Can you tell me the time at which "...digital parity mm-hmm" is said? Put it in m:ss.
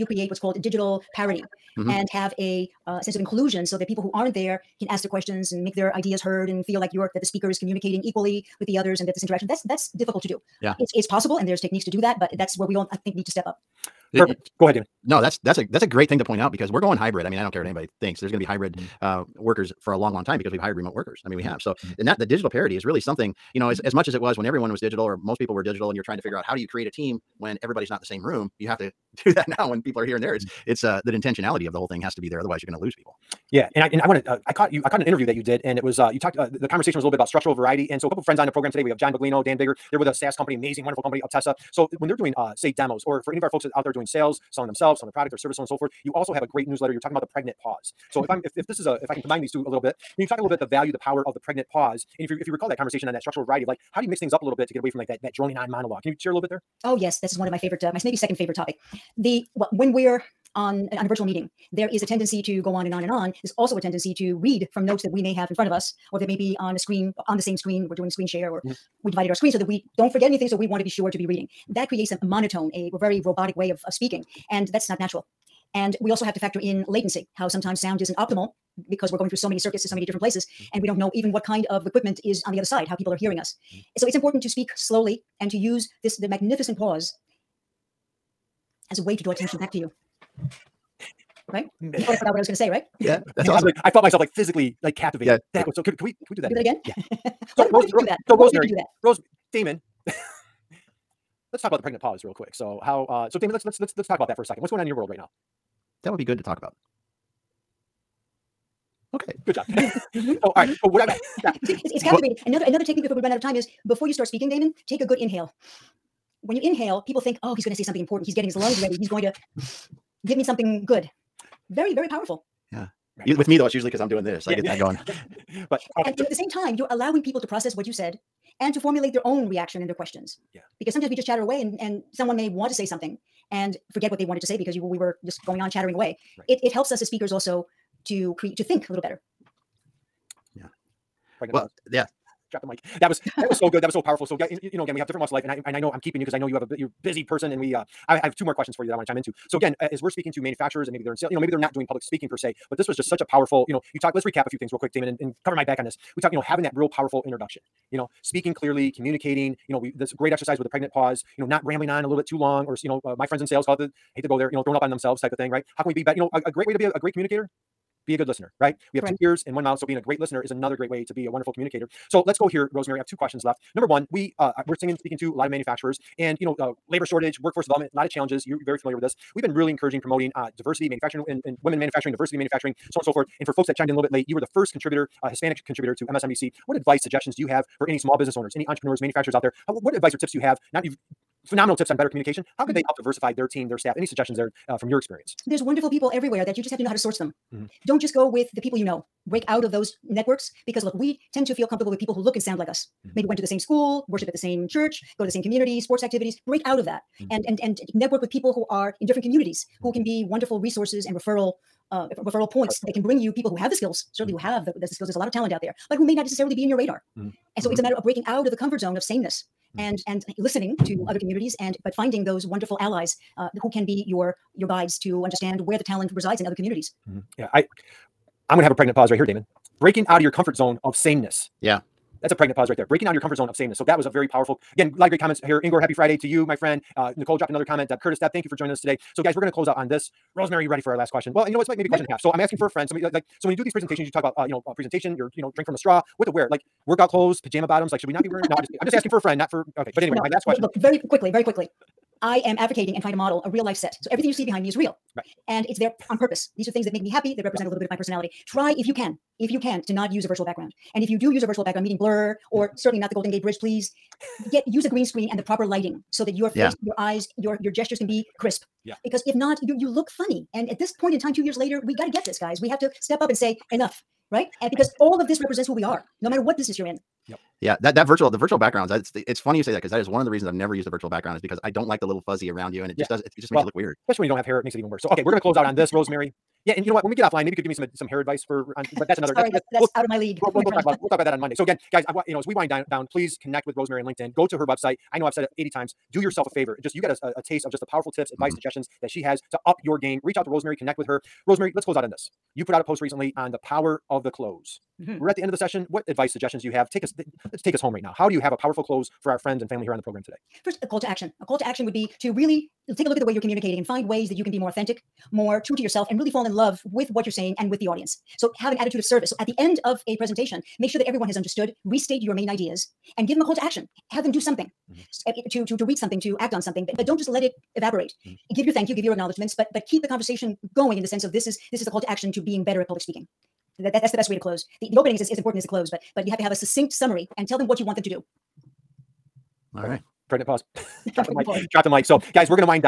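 0:00.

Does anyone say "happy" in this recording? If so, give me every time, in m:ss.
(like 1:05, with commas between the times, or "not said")
3:55, 4:17.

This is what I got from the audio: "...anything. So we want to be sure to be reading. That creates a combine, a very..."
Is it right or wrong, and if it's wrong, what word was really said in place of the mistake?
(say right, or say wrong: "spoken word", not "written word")
wrong: "monotone", not "combine".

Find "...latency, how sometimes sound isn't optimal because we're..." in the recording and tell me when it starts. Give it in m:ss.
1:16.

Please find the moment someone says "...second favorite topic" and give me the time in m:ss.
0:58.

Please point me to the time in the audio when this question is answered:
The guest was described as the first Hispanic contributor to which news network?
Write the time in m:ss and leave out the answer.
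3:06.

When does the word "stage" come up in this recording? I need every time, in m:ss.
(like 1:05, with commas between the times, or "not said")
not said.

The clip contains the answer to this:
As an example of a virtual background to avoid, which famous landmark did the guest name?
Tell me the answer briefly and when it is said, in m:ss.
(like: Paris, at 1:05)
Golden Gate Bridge, at 4:23.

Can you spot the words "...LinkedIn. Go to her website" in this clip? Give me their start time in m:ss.
4:54.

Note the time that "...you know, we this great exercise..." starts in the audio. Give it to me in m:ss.
2:39.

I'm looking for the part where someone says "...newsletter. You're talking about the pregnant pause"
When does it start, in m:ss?
0:46.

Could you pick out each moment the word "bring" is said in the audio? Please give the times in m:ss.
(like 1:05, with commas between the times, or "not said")
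3:33.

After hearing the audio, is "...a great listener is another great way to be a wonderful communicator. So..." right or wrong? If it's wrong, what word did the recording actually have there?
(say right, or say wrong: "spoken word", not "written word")
right.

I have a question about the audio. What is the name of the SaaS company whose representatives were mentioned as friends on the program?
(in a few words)
Uptessa.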